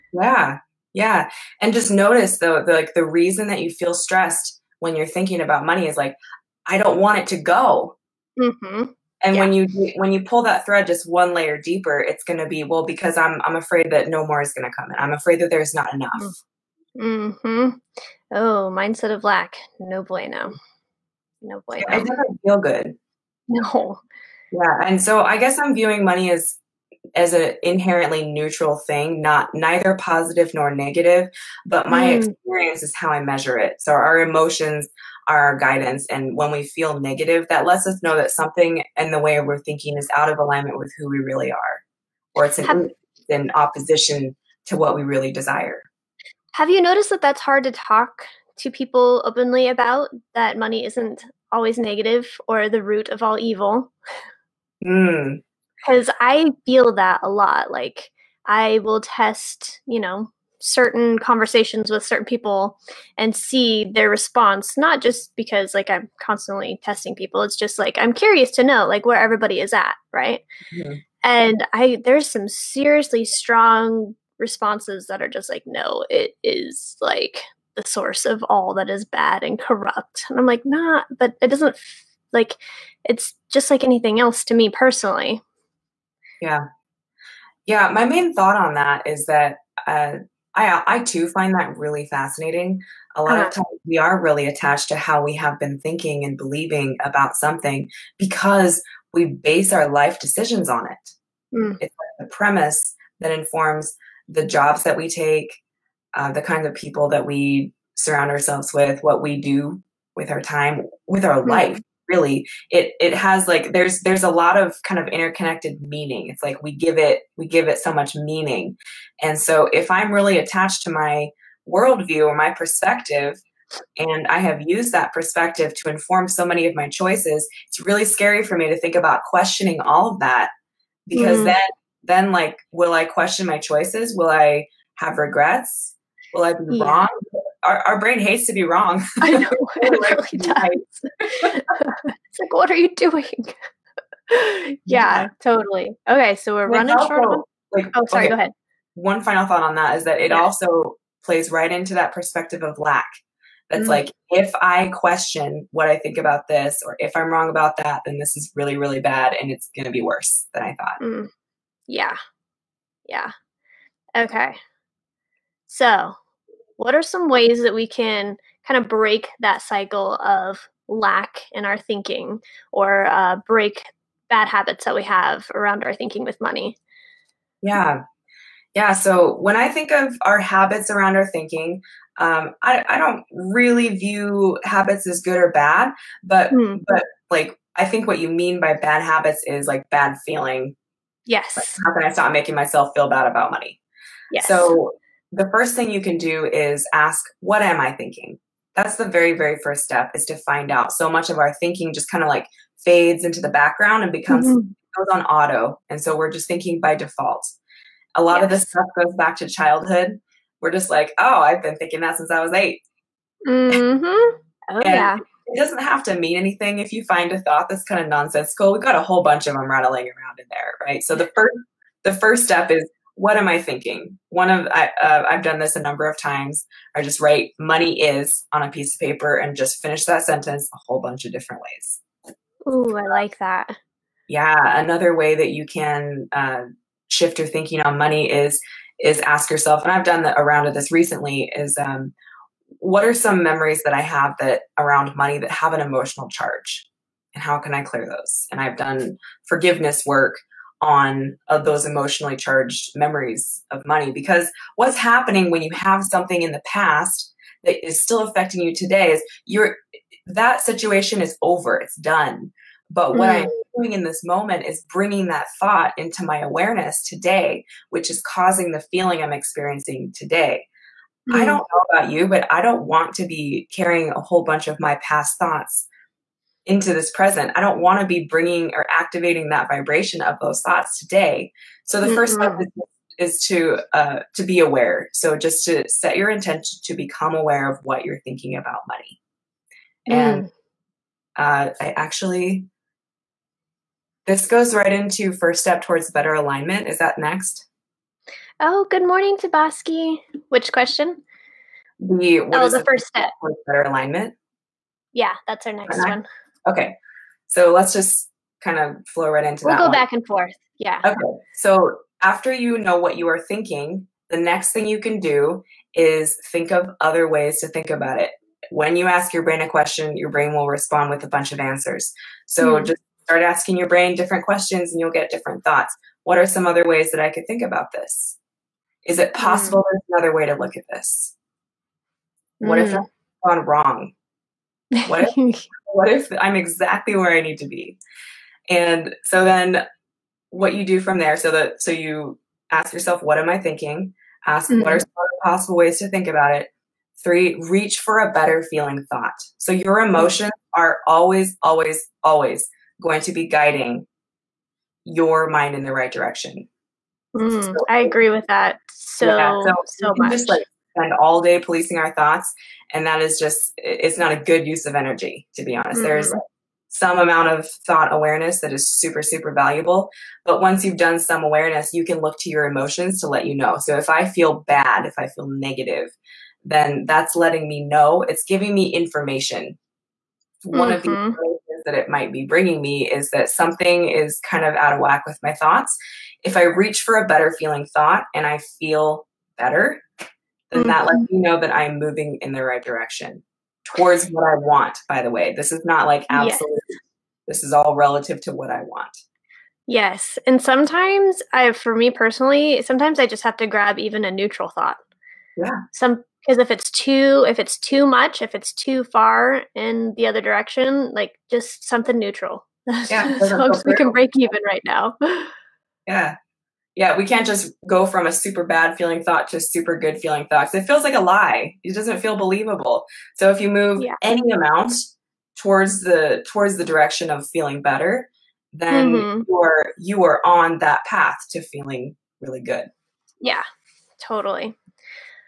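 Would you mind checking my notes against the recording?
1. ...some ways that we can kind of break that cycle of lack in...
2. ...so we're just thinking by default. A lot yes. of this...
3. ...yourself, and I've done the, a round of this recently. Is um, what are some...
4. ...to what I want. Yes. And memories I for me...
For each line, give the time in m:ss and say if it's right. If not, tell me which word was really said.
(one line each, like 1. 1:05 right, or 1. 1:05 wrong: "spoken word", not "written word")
1. 2:47 right
2. 3:26 right
3. 3:59 right
4. 6:38 wrong: "sometimes", not "memories".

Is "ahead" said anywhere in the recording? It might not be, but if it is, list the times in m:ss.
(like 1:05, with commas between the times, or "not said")
2:28.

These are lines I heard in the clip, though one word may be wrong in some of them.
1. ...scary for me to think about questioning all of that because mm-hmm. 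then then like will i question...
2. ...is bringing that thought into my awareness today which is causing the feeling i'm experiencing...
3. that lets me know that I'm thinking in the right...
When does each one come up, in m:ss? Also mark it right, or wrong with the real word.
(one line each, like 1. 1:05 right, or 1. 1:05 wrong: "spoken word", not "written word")
1. 2:08 right
2. 4:24 right
3. 6:30 wrong: "moving", not "thinking".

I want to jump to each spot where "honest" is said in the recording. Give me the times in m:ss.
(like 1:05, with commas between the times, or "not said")
6:05.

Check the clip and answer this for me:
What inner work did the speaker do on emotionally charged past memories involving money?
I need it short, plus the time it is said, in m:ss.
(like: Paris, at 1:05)
forgiveness work, at 4:09.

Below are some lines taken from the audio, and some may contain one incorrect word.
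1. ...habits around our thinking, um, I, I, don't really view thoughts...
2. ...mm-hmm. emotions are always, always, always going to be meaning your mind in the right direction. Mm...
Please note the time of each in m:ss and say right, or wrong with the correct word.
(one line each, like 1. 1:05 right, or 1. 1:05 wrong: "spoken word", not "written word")
1. 3:00 wrong: "habits", not "thoughts"
2. 5:49 wrong: "guiding", not "meaning".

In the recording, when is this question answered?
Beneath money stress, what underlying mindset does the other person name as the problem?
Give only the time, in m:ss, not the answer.
0:18.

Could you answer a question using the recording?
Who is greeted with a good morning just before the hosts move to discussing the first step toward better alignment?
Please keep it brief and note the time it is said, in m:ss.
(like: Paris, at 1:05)
Tabaski, at 4:59.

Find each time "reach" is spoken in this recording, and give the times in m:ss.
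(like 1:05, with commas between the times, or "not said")
5:47, 6:26.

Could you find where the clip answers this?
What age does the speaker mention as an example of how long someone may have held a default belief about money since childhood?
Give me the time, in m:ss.
3:32.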